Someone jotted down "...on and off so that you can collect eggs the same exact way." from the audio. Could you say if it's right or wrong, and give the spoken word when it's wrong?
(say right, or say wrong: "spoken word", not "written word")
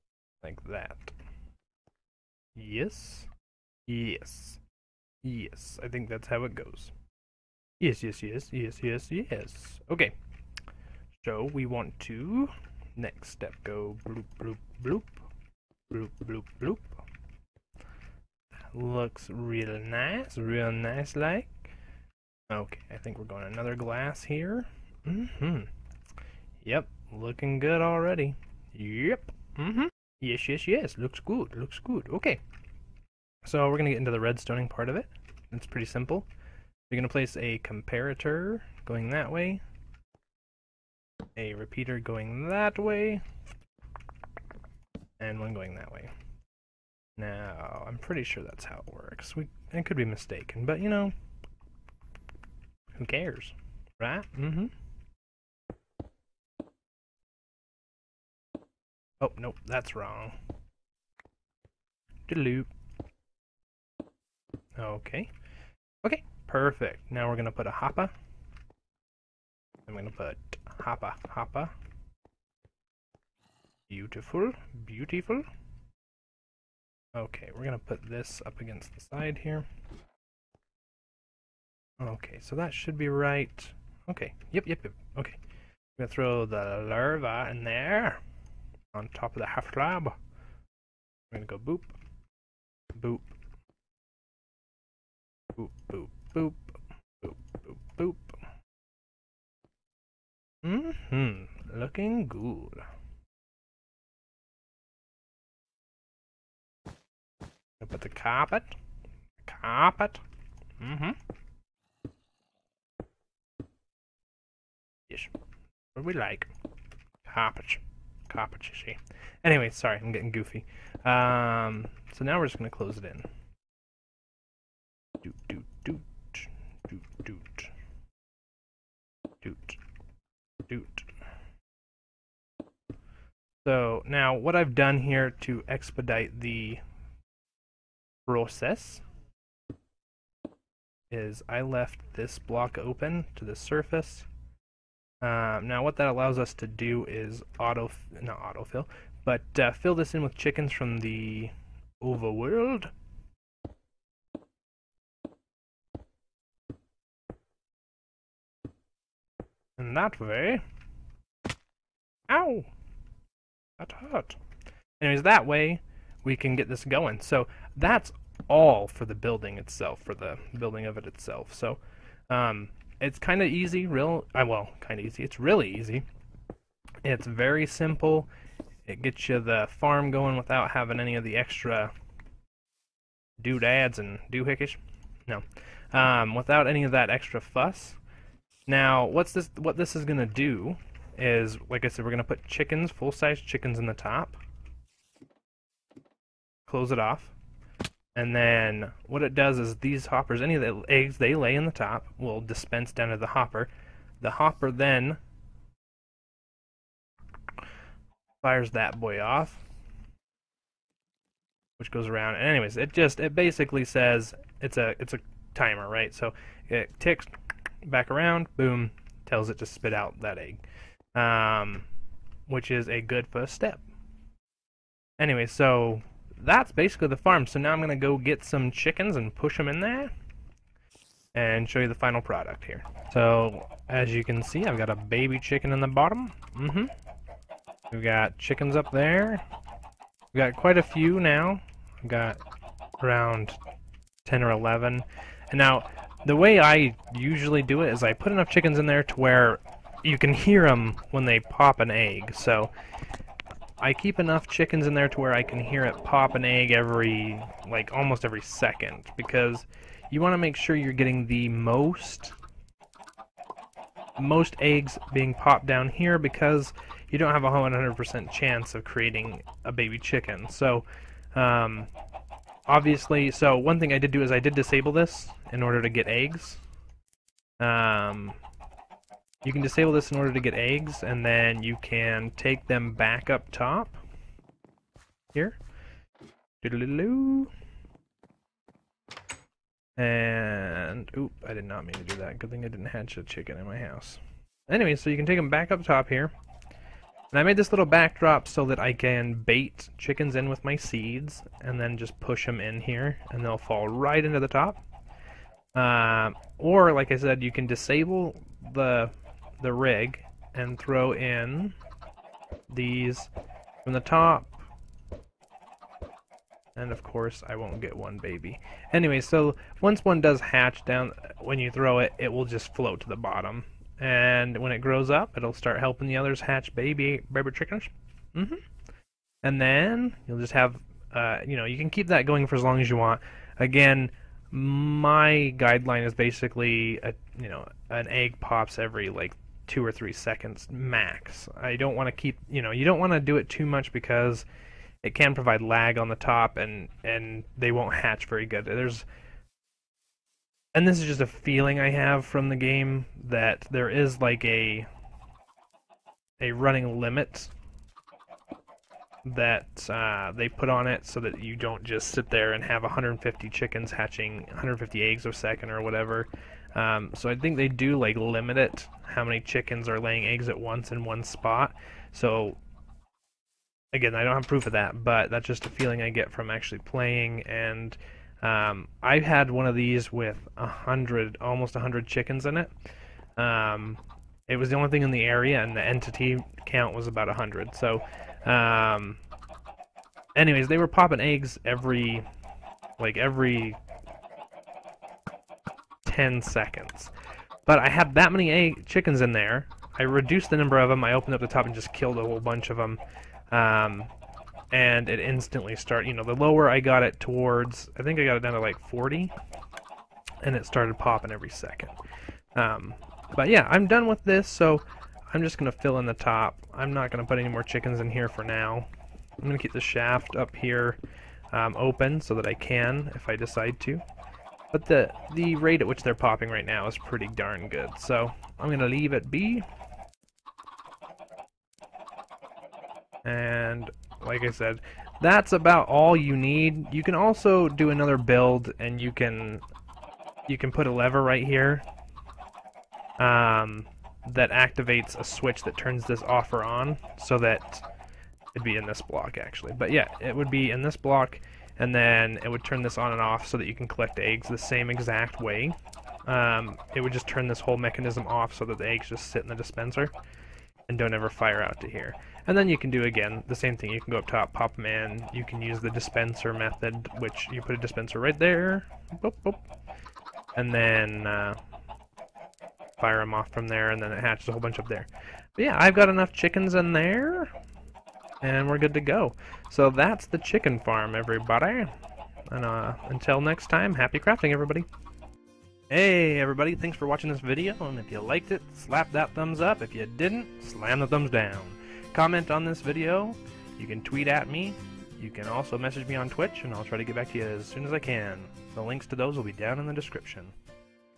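right.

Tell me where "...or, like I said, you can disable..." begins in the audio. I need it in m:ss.
5:06.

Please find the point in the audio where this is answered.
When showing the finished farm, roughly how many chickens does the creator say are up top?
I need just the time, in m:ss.
4:04.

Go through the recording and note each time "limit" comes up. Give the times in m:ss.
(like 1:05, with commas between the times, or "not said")
5:56, 6:08.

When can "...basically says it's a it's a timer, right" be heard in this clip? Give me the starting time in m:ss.
3:33.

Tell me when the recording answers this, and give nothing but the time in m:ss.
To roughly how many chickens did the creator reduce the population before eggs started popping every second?
6:48.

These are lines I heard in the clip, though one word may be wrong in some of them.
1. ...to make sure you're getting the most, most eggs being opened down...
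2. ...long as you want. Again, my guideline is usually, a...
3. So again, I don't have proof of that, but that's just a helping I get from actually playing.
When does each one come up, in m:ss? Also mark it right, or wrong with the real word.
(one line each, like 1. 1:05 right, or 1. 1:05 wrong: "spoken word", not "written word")
1. 4:20 wrong: "popped", not "opened"
2. 5:32 wrong: "basically", not "usually"
3. 6:12 wrong: "feeling", not "helping".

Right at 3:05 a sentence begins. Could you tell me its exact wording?
No, um, without any of that extra fuss.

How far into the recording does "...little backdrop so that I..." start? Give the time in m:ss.
4:57.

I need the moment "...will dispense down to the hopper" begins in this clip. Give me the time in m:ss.
3:22.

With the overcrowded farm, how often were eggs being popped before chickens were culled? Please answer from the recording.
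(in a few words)
every 10 seconds.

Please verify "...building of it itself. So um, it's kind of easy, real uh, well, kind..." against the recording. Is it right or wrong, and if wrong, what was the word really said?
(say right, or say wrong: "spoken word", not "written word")
right.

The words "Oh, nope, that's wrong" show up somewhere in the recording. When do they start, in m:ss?
0:59.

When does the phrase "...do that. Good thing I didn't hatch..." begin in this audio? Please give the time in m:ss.
4:52.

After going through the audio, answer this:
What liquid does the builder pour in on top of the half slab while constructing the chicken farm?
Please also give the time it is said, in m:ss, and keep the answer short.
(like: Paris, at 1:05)
lava, at 1:26.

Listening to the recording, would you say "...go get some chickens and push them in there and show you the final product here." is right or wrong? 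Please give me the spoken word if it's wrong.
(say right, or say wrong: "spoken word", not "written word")
right.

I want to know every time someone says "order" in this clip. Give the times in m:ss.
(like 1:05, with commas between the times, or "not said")
4:35, 4:40.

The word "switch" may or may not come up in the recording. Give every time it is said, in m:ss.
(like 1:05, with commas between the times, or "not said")
7:25.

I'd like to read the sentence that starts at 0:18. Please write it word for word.
Looks real nice, real nice like.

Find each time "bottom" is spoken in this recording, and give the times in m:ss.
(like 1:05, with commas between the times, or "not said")
3:55, 5:23.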